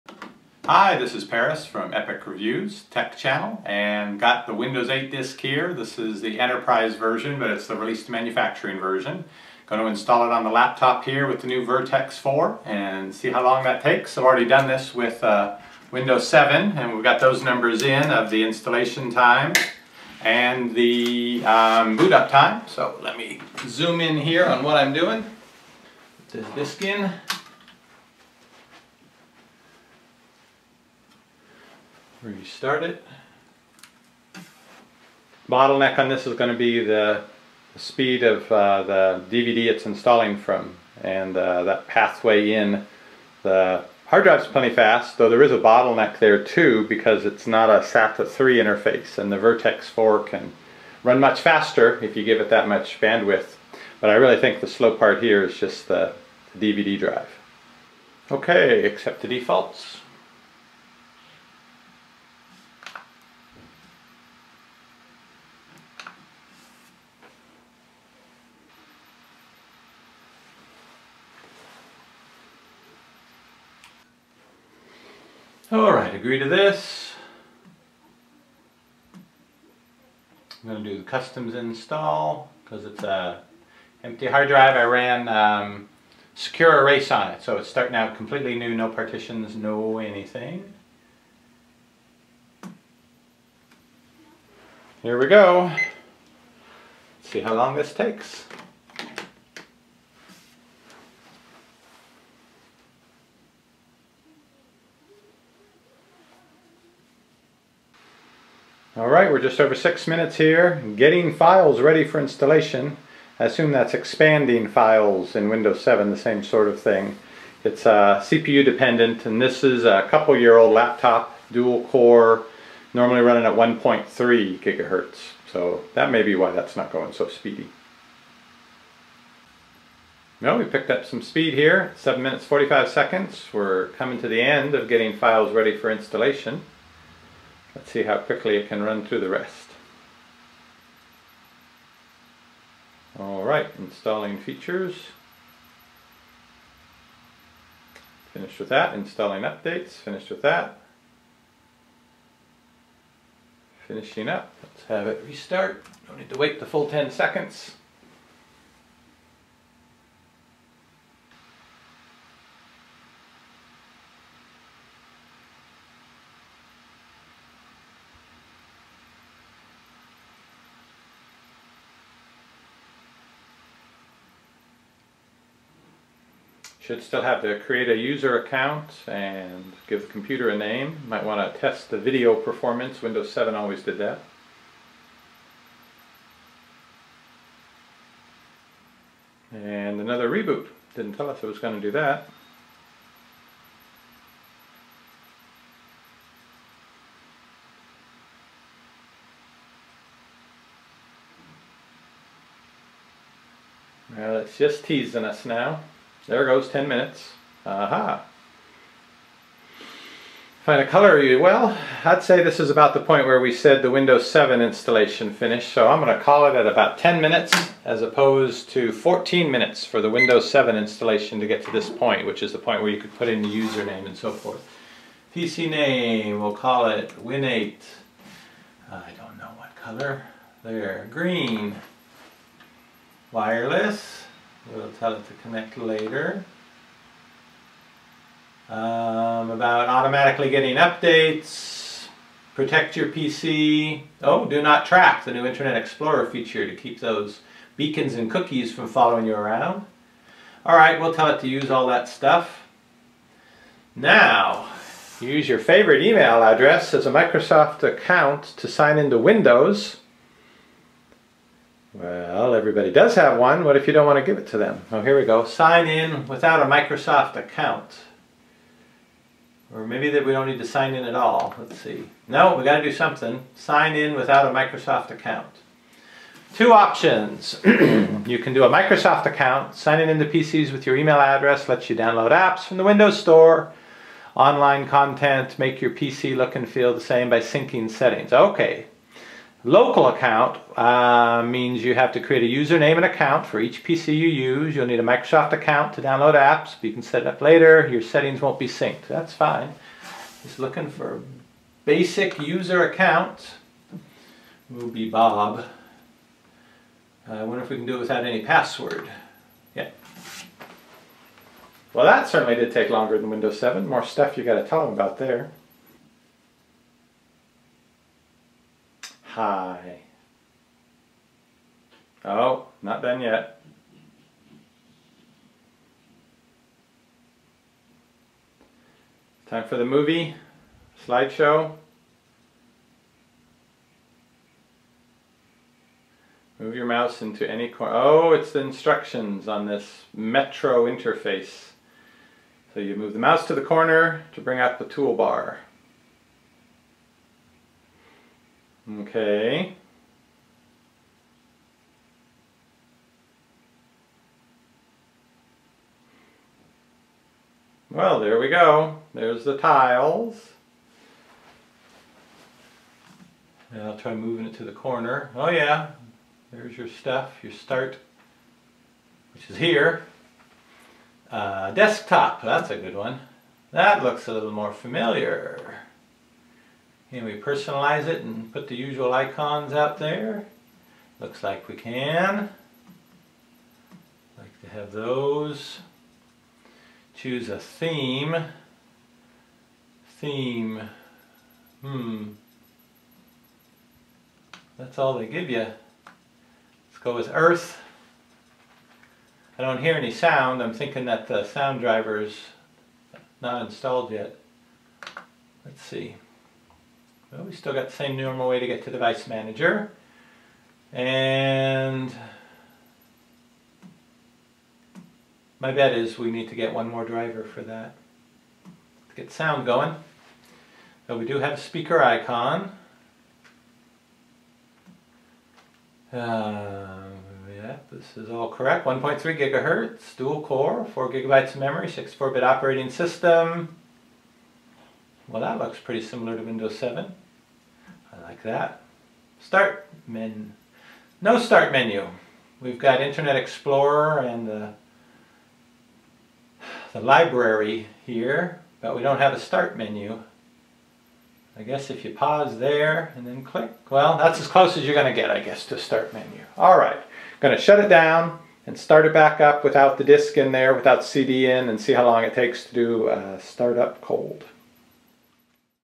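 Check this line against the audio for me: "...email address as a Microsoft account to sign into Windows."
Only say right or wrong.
right.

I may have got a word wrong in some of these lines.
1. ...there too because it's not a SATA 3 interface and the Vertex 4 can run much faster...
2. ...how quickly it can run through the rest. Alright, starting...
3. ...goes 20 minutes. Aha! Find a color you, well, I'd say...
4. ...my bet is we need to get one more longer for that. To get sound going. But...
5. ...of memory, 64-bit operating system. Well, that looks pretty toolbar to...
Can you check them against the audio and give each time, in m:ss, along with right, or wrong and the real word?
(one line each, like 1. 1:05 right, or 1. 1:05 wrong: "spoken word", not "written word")
1. 0:46 right
2. 2:18 wrong: "installing", not "starting"
3. 3:26 wrong: "10", not "20"
4. 6:55 wrong: "driver", not "longer"
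5. 7:11 wrong: "similar", not "toolbar".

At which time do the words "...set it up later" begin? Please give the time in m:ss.
4:57.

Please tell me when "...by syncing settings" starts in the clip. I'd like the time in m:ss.
4:47.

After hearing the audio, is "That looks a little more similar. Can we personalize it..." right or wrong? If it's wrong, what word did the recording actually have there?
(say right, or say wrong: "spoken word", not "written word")
wrong: "familiar", not "similar".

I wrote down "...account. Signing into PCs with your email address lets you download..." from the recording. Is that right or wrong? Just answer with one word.
right.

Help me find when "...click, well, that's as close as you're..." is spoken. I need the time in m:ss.
7:33.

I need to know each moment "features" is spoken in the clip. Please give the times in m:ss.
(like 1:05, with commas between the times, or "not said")
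2:24, 4:06.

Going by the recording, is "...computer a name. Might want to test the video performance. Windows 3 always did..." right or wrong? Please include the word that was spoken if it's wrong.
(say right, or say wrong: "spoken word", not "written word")
wrong: "7", not "3".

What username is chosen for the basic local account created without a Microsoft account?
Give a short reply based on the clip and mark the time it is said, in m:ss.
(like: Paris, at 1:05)
Bob, at 5:05.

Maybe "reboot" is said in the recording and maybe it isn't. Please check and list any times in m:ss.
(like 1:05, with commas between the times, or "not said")
3:10.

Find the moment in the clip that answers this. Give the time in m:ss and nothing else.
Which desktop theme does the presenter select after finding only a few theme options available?
6:37.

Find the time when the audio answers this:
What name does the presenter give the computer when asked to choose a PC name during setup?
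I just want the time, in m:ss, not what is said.
3:47.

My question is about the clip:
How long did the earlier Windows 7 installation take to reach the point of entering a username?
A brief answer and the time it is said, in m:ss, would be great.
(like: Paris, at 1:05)
14 minutes, at 3:38.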